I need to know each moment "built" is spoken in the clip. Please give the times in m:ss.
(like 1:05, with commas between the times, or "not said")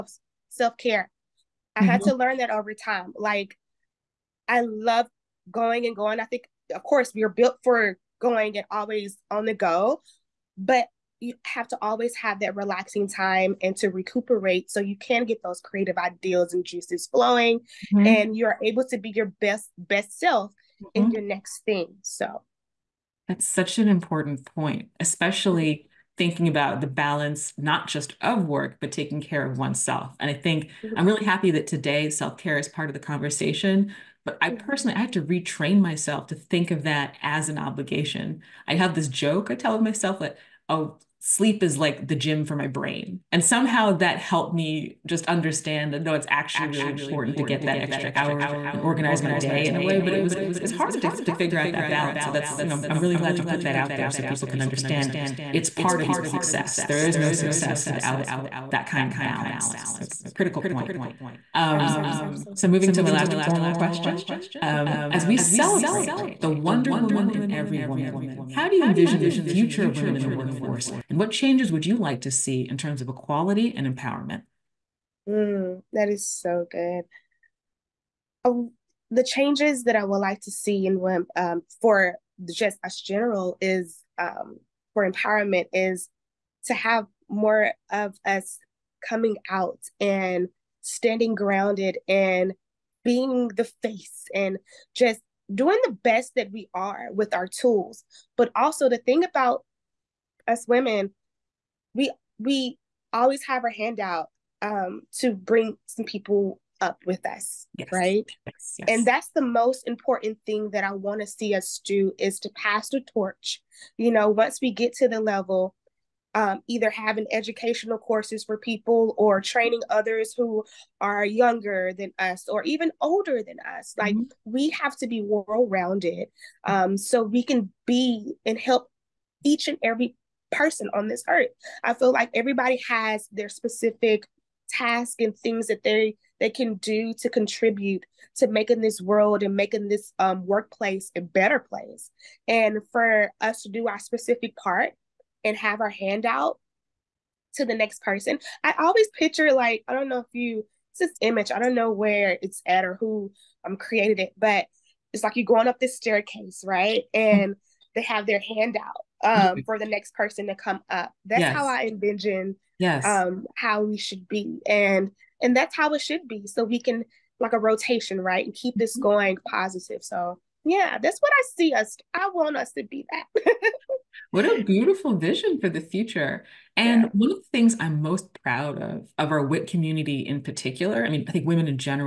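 0:07.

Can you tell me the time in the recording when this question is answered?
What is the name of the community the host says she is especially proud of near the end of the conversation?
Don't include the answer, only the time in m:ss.
2:59.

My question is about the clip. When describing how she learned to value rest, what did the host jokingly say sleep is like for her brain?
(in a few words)
the gym.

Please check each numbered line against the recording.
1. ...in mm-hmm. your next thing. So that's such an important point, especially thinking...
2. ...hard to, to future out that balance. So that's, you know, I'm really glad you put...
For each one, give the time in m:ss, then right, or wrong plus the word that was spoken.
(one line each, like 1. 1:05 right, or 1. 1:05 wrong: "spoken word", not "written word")
1. 0:20 right
2. 0:50 wrong: "figure", not "future".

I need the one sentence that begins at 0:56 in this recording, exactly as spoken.
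There is no success without that kind of balance.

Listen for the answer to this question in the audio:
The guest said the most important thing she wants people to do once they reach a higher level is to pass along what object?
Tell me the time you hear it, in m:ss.
1:52.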